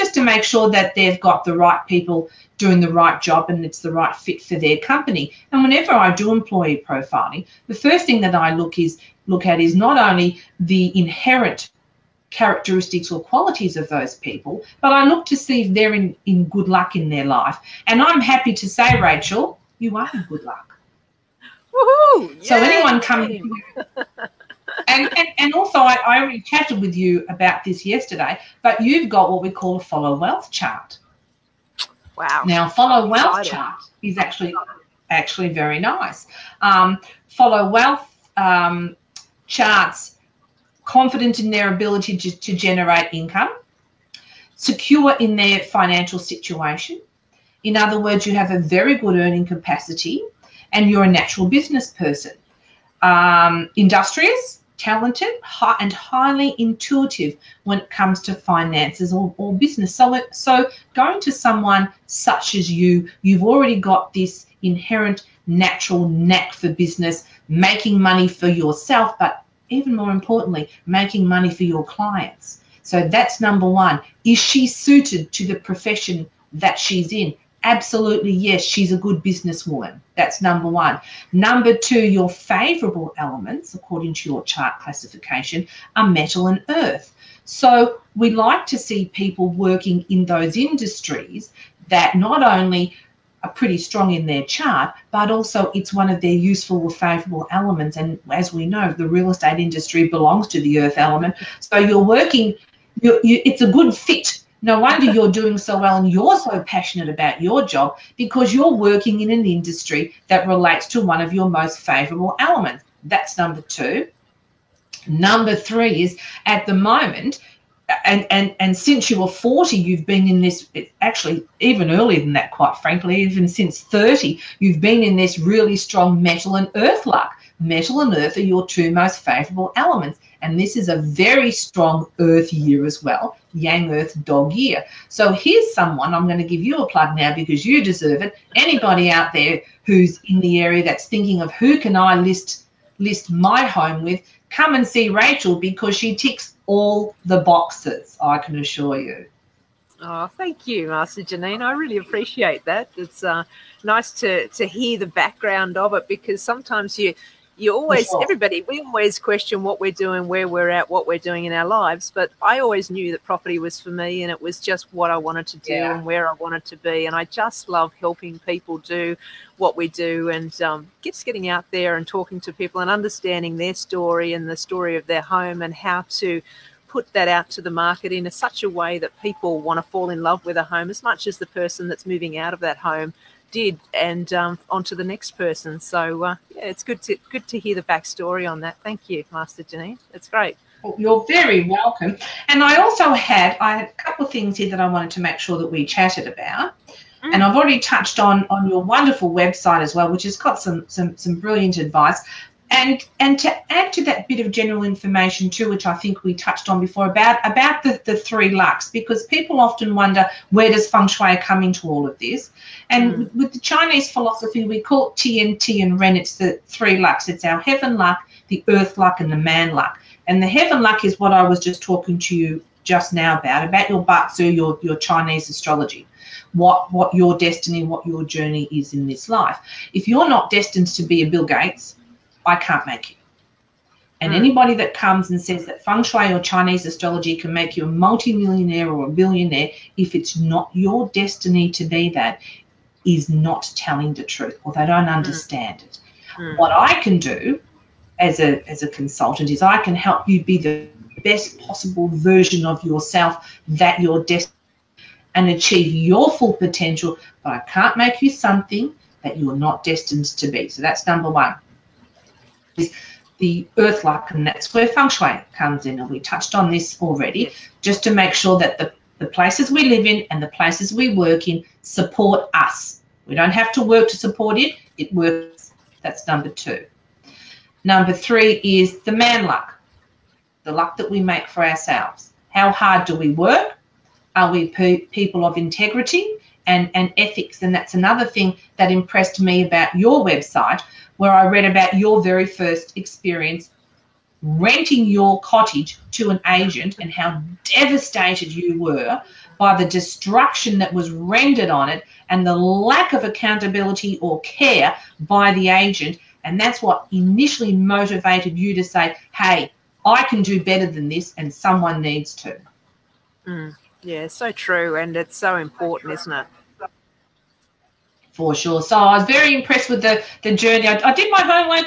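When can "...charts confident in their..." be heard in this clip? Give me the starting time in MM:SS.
00:39.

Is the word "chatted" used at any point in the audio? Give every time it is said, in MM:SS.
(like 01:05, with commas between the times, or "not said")
00:26, 03:15.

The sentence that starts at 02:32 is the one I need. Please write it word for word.
It's uh, nice to, to hear the background of it because sometimes you you always sure.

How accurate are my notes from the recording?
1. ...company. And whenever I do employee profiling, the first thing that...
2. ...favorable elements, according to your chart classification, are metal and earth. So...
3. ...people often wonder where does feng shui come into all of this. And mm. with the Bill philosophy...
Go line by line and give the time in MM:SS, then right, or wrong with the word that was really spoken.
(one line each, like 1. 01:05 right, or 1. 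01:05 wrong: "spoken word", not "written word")
1. 00:04 right
2. 01:22 right
3. 03:29 wrong: "Chinese", not "Bill".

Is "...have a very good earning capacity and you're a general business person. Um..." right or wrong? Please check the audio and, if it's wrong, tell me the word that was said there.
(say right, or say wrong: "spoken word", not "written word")
wrong: "natural", not "general".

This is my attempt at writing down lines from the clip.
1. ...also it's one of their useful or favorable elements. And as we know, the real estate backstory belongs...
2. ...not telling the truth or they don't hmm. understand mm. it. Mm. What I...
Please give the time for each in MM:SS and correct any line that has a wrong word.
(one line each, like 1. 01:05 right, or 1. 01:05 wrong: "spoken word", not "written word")
1. 01:35 wrong: "industry", not "backstory"
2. 04:03 right.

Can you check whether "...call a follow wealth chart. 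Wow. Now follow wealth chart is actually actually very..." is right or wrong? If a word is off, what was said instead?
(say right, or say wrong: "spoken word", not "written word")
right.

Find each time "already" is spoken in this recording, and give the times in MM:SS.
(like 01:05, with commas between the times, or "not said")
00:26, 01:03, 03:17, 04:27.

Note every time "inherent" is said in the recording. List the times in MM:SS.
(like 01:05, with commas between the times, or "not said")
00:10, 01:04.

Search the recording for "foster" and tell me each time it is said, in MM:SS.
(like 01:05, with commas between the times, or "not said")
not said.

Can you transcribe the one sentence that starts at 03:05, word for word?
So uh, yeah, it's good to good to hear the backstory on that.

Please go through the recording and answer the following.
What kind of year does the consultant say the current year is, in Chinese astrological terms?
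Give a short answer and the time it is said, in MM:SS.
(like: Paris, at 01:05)
Yang earth dog year, at 02:13.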